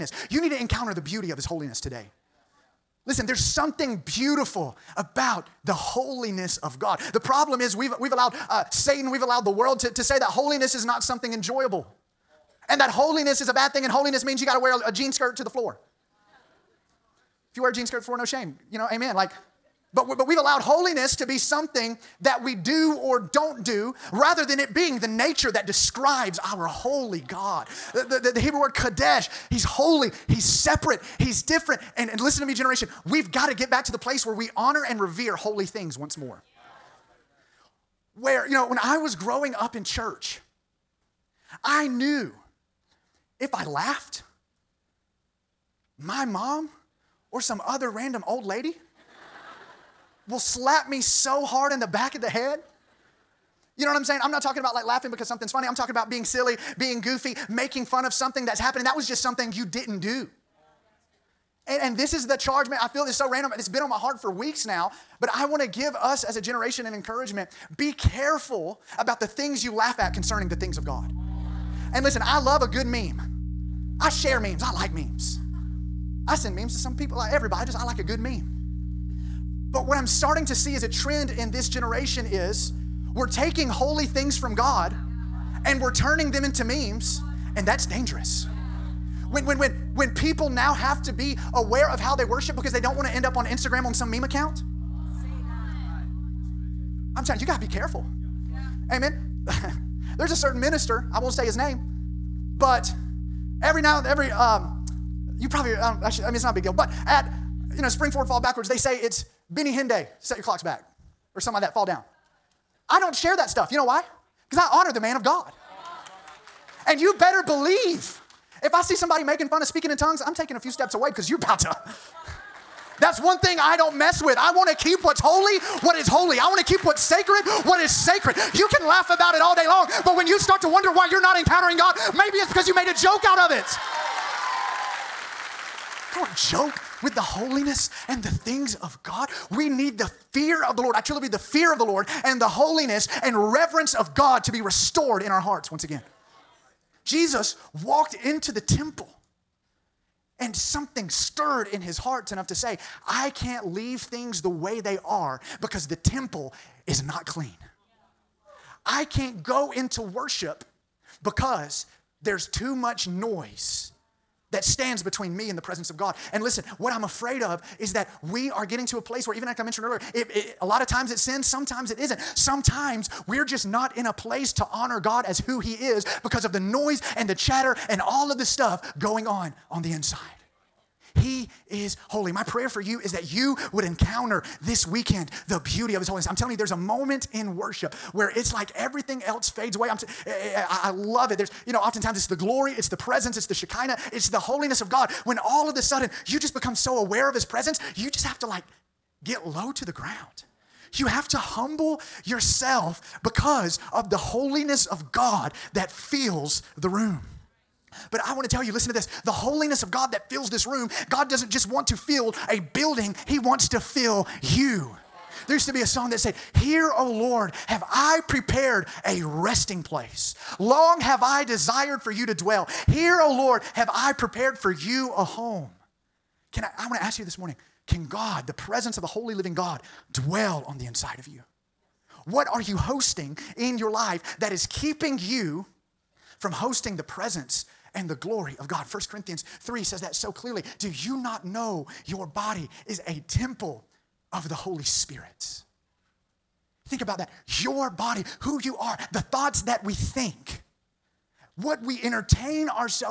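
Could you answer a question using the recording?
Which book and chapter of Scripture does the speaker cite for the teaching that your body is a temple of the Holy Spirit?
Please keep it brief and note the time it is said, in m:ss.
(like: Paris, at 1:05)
1 Corinthians 3, at 3:58.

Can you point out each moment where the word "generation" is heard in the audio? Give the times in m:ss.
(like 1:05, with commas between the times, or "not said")
0:32, 1:06, 1:21.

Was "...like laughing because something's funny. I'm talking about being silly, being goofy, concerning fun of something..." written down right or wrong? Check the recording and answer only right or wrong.
wrong.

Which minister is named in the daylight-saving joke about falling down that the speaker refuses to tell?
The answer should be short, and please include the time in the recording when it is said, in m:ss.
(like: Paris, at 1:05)
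Benny Hinn, at 1:49.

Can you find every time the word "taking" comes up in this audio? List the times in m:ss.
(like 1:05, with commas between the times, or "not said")
1:23, 2:00.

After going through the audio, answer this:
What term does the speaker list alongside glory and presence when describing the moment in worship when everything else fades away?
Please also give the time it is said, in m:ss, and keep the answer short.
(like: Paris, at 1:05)
Shekinah, at 3:13.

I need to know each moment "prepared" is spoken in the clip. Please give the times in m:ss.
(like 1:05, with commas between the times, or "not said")
3:38, 3:44.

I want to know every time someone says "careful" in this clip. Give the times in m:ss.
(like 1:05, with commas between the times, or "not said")
1:07, 1:37.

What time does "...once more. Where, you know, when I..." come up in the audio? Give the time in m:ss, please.
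0:35.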